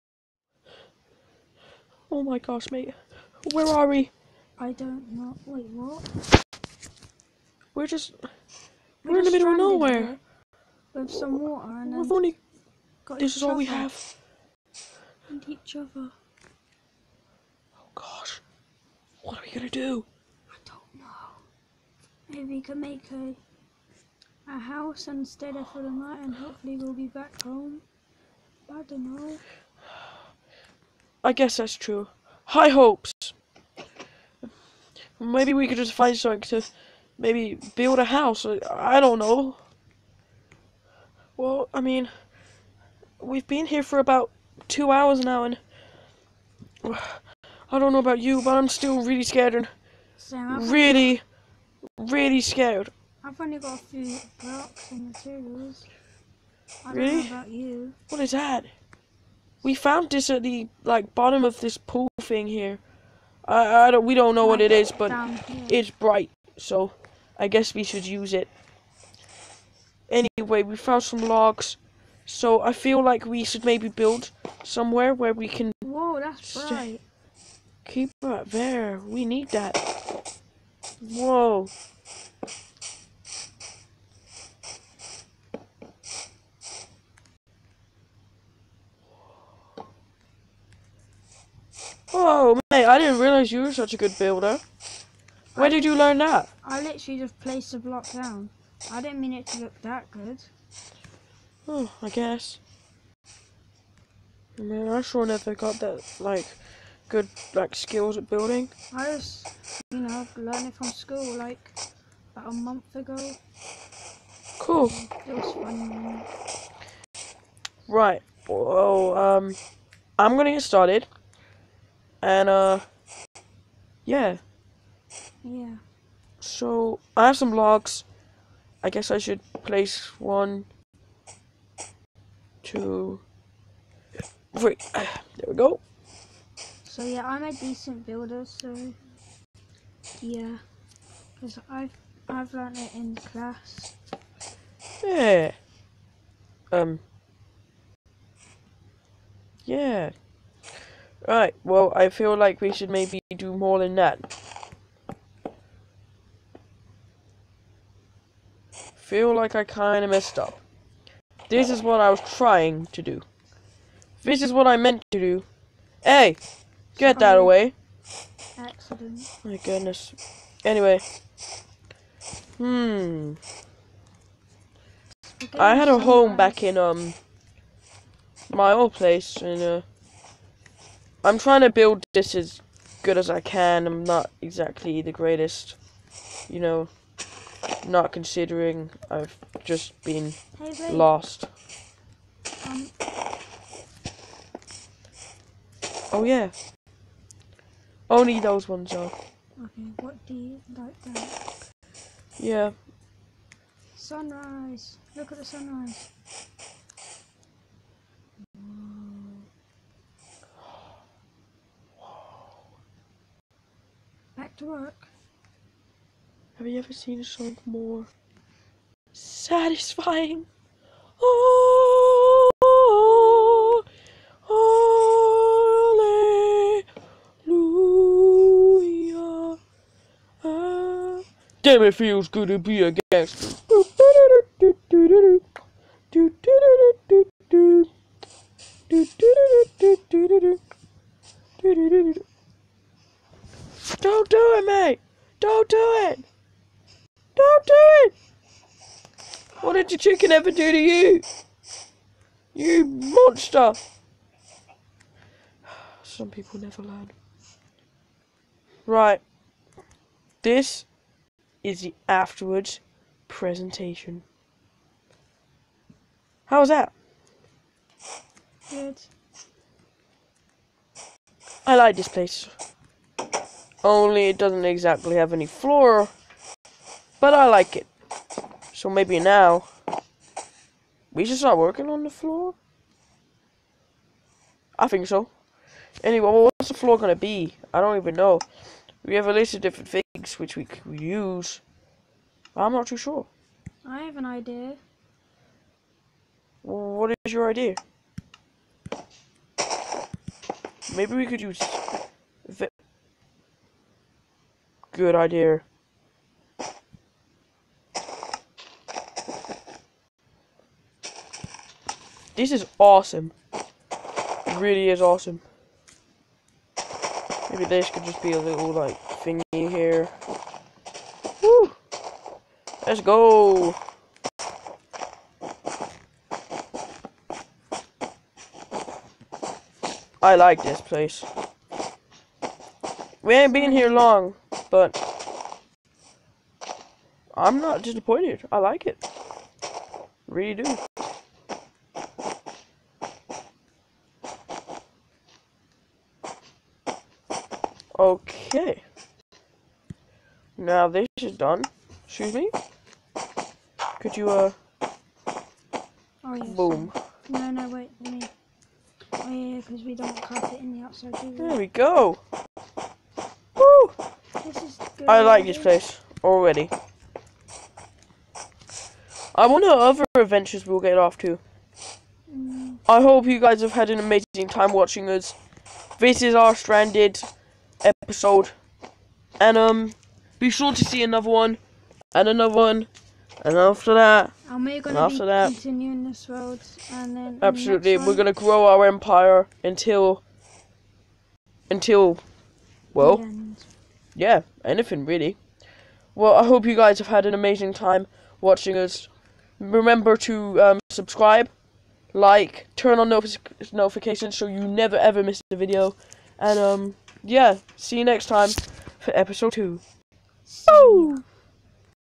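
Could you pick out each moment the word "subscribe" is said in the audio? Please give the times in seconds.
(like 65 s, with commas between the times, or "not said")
400 s.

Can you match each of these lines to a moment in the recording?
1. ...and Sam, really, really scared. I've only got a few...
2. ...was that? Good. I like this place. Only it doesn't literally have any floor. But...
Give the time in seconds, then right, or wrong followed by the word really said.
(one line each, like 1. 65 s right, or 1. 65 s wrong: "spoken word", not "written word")
1. 49 s right
2. 266 s wrong: "exactly", not "literally".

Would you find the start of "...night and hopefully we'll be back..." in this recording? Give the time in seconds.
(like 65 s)
25 s.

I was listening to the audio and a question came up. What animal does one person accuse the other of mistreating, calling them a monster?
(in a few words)
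Chicken.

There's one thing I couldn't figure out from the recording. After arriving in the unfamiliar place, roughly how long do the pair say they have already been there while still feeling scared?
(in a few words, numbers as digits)
2 hours.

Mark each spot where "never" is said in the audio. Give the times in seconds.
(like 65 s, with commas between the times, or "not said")
105 s, 256 s, 404 s.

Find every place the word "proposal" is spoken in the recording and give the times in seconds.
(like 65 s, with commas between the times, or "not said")
not said.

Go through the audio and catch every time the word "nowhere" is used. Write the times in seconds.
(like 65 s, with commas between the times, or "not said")
9 s.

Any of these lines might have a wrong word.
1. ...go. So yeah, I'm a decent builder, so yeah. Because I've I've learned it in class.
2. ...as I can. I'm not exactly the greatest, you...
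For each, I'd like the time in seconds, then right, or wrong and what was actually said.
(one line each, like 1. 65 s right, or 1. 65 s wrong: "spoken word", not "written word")
1. 135 s right
2. 183 s right.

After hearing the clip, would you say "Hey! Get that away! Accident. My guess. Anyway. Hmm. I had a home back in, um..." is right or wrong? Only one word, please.
wrong.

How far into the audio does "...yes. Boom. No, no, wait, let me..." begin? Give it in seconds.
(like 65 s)
356 s.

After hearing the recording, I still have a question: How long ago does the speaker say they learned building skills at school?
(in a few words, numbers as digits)
About a month ago.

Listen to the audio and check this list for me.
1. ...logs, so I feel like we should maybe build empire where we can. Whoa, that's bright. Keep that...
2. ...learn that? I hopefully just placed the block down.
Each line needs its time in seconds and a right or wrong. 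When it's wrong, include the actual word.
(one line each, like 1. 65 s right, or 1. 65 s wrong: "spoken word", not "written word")
1. 71 s wrong: "somewhere", not "empire"
2. 95 s wrong: "literally", not "hopefully".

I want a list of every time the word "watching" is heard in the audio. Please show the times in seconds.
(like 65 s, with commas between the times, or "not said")
374 s, 398 s.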